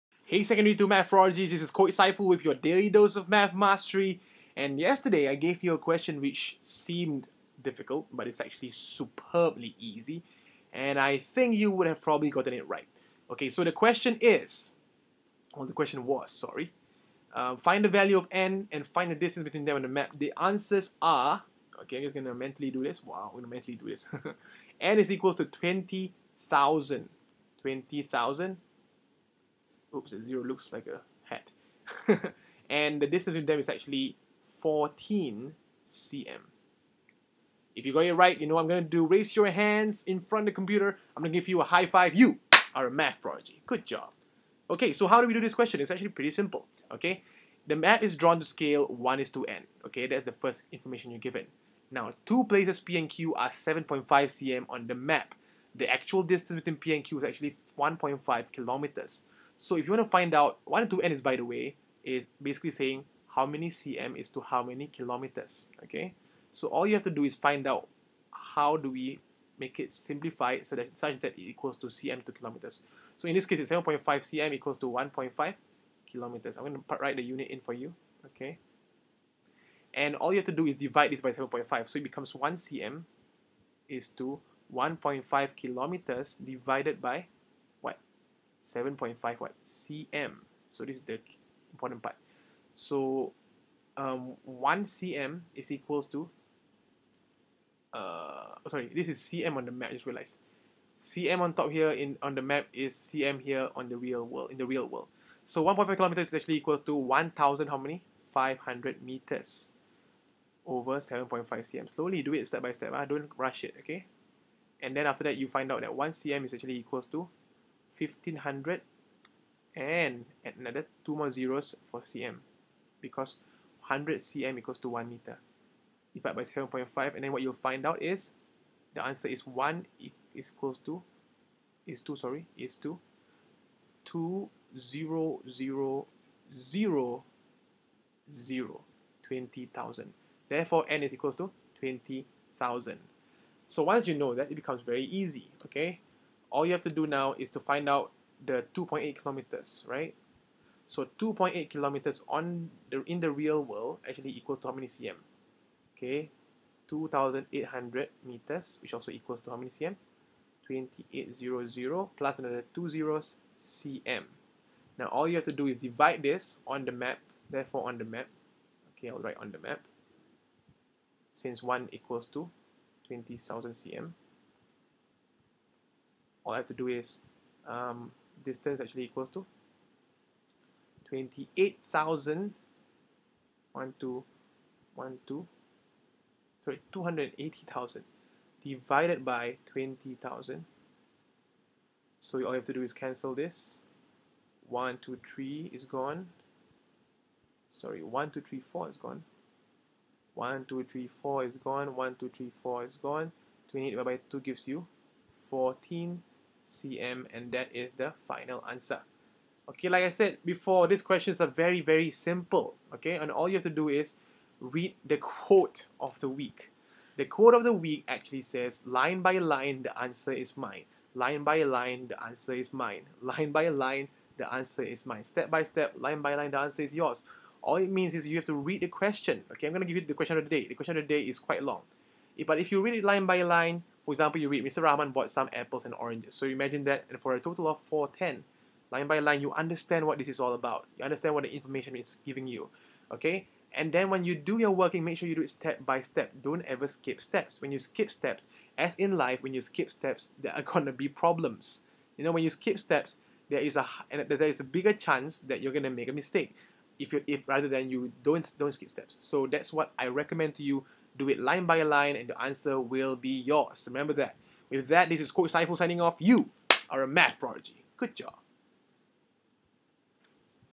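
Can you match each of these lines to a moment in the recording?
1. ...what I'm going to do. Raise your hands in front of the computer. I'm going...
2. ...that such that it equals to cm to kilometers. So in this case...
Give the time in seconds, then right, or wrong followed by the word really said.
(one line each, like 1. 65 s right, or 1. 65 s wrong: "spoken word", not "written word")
1. 38 s right
2. 70 s right.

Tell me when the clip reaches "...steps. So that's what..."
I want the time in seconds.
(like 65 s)
258 s.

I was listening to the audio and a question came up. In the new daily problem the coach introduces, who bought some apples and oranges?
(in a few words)
Mr. Rahman.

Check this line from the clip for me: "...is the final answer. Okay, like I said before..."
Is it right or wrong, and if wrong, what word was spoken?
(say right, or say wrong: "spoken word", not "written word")
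right.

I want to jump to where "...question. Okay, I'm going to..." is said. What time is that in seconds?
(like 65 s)
228 s.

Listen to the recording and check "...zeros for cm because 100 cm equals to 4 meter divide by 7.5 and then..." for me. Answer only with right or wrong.
wrong.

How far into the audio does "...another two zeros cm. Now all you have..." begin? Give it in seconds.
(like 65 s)
162 s.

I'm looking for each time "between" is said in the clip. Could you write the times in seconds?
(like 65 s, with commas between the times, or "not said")
19 s, 33 s, 56 s.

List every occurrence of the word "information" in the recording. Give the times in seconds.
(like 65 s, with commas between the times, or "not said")
50 s, 241 s.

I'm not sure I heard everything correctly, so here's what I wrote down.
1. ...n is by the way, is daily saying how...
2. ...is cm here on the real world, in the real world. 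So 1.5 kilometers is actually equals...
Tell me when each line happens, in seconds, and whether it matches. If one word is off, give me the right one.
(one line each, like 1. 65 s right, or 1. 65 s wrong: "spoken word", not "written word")
1. 61 s wrong: "basically", not "daily"
2. 102 s right.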